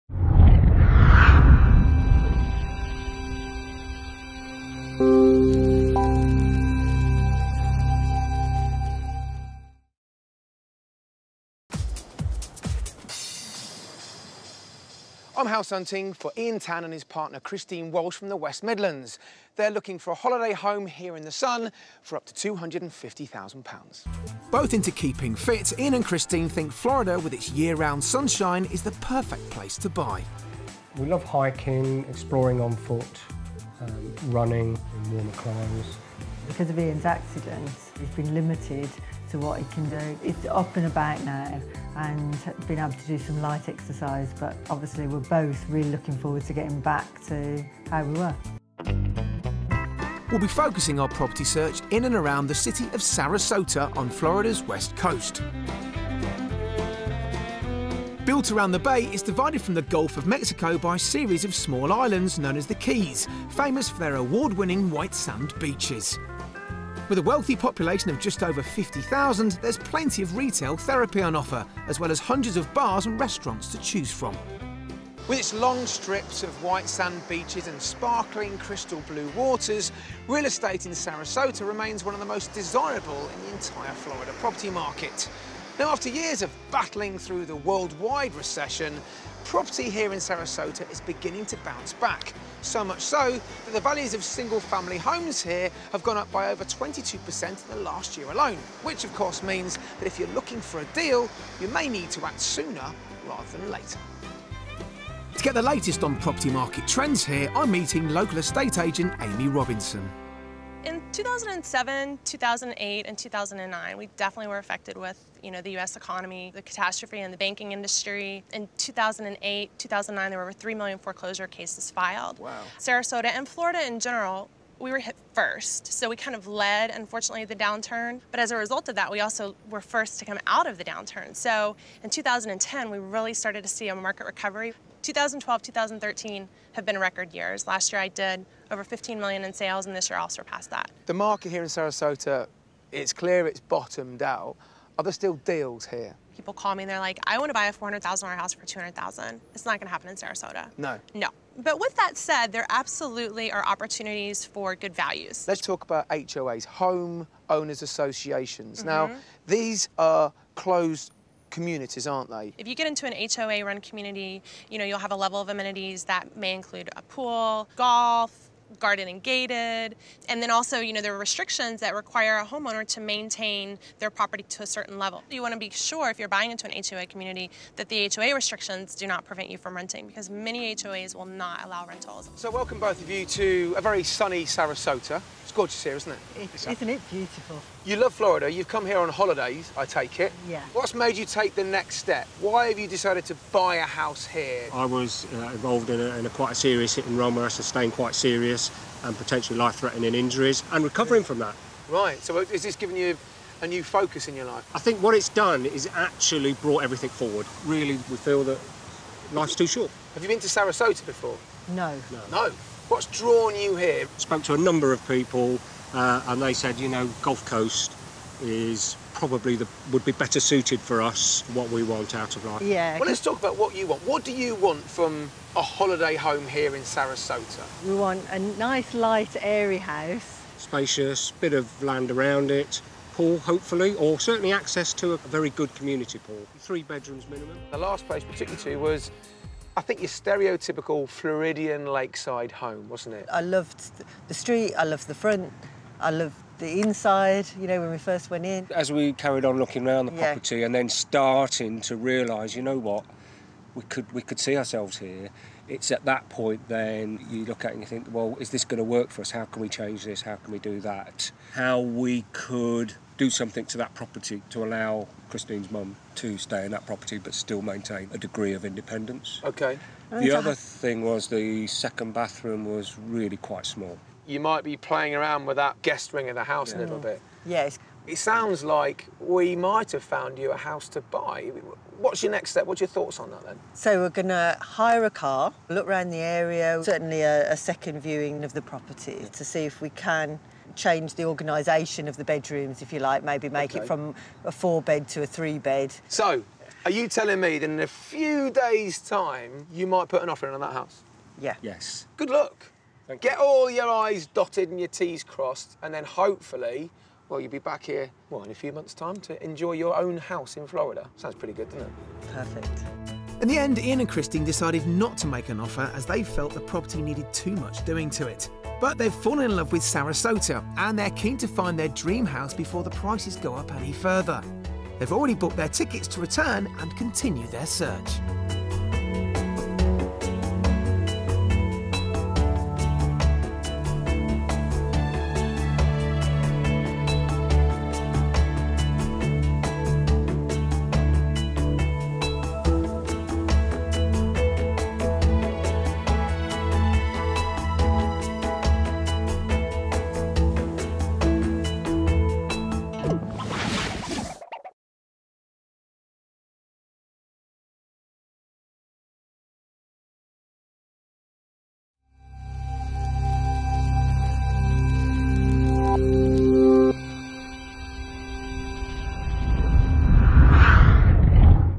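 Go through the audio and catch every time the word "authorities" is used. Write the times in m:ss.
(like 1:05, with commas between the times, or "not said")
not said.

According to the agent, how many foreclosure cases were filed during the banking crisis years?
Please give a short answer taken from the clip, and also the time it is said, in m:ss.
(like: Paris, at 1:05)
over 3 million, at 2:00.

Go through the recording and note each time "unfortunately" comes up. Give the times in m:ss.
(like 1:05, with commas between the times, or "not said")
2:06.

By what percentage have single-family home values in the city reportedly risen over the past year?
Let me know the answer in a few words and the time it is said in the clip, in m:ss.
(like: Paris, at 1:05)
22%, at 1:36.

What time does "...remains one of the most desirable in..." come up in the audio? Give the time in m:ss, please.
1:21.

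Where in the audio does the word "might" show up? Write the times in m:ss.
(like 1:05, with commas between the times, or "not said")
4:34, 4:39, 4:59.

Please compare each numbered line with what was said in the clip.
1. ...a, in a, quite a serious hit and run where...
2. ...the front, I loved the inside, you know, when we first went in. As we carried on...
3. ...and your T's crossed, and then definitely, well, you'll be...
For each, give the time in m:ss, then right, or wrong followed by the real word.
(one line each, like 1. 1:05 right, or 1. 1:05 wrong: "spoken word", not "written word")
1. 3:15 right
2. 4:05 right
3. 5:04 wrong: "hopefully", not "definitely".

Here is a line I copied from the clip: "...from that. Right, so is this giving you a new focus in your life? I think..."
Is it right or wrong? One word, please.
right.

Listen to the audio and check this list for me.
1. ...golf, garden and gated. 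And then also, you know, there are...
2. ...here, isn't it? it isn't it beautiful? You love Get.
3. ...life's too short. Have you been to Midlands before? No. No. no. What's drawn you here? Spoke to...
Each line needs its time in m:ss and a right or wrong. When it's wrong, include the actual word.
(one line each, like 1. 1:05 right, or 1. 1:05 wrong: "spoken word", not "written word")
1. 2:47 right
2. 3:05 wrong: "Florida", not "Get"
3. 3:29 wrong: "Sarasota", not "Midlands".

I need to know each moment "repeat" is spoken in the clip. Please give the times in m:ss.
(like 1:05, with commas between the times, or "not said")
not said.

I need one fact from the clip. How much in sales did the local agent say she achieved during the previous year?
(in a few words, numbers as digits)
15 million.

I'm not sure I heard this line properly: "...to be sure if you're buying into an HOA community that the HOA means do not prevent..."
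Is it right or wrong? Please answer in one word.
wrong.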